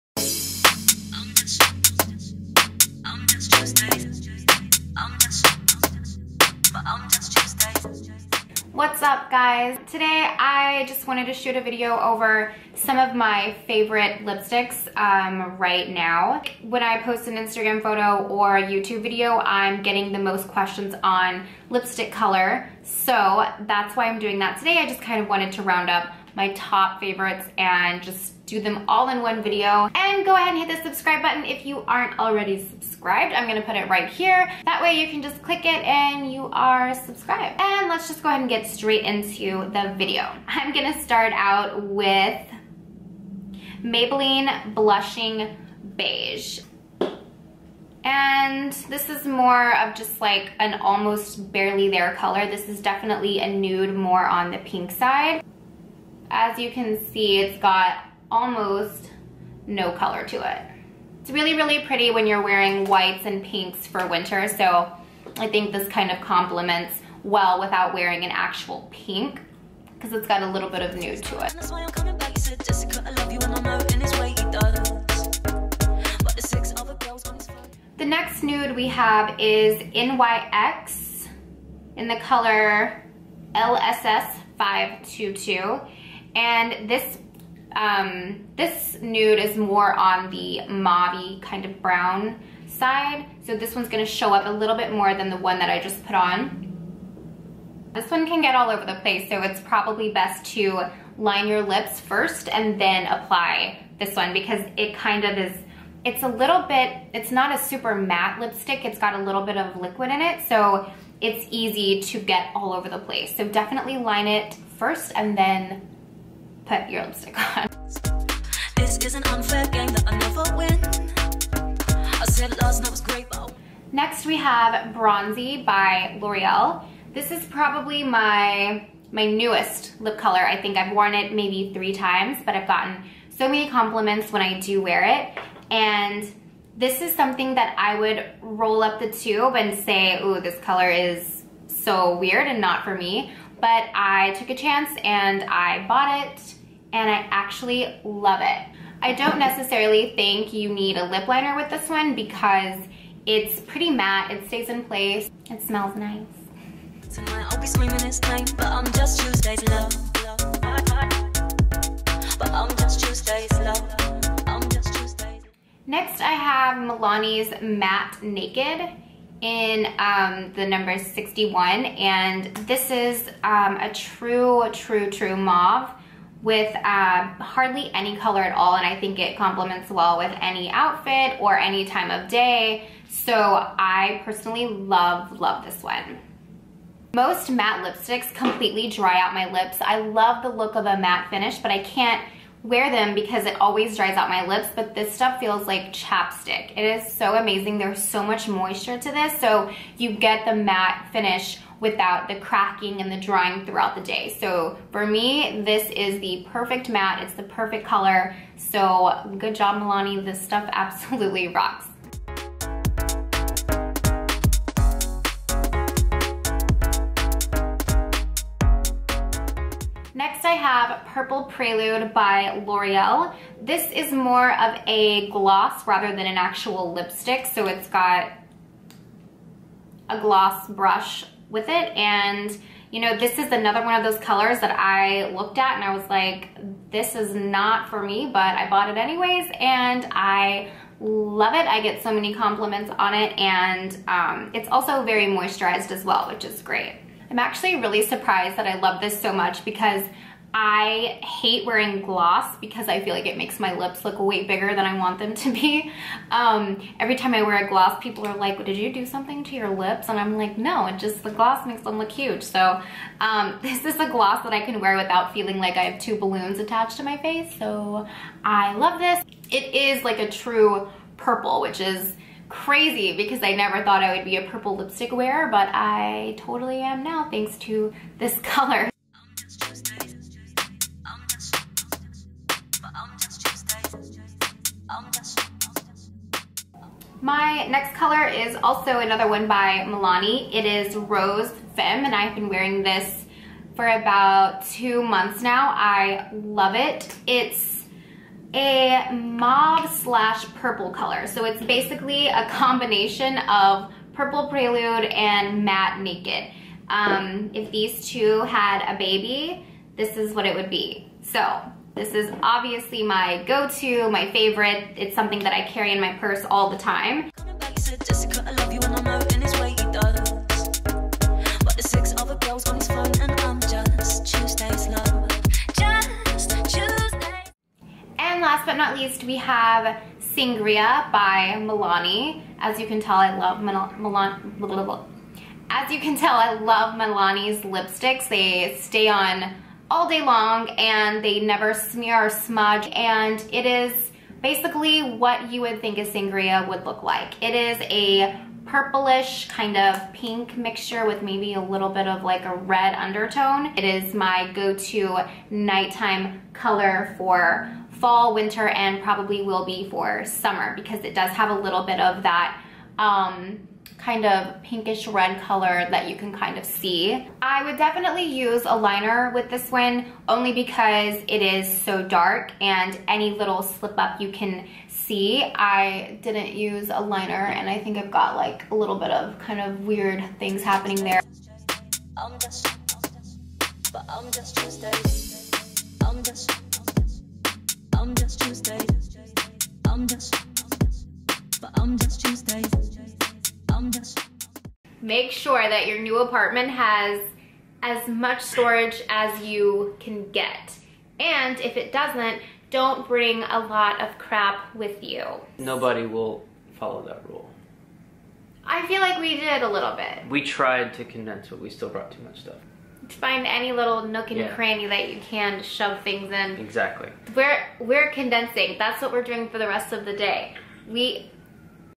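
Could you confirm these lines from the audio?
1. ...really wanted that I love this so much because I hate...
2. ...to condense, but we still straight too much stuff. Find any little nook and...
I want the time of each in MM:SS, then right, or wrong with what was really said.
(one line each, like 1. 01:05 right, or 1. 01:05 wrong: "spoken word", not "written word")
1. 04:07 wrong: "surprised", not "wanted"
2. 06:50 wrong: "brought", not "straight".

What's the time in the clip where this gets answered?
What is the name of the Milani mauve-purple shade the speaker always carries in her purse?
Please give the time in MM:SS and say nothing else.
04:50.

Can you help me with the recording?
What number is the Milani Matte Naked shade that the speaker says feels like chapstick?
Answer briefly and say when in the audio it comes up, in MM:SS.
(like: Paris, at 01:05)
61, at 02:50.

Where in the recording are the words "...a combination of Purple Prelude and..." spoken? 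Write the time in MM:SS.
05:02.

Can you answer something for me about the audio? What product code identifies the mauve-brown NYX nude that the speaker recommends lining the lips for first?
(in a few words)
LSS 522.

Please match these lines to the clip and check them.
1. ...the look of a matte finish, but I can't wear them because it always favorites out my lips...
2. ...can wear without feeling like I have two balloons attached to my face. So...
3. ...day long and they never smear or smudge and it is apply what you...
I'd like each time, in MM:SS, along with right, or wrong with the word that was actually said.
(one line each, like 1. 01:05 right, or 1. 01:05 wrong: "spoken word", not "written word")
1. 03:10 wrong: "dries", not "favorites"
2. 04:24 right
3. 05:40 wrong: "basically", not "apply".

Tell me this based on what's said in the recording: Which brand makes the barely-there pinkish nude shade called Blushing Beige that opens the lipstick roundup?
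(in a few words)
Maybelline.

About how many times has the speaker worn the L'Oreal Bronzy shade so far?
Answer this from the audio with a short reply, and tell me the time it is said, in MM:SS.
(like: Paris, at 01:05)
3, at 02:11.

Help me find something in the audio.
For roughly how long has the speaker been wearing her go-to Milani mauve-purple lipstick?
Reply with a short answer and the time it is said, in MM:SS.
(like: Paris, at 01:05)
2 months, at 04:54.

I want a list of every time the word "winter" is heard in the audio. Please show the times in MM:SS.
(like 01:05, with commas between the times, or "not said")
01:04, 05:58.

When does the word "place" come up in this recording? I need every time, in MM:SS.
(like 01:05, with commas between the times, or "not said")
01:38, 01:52, 02:34.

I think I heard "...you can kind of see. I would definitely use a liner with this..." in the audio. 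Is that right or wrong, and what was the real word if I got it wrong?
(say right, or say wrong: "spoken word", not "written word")
right.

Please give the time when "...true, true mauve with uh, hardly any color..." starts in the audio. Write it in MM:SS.
02:54.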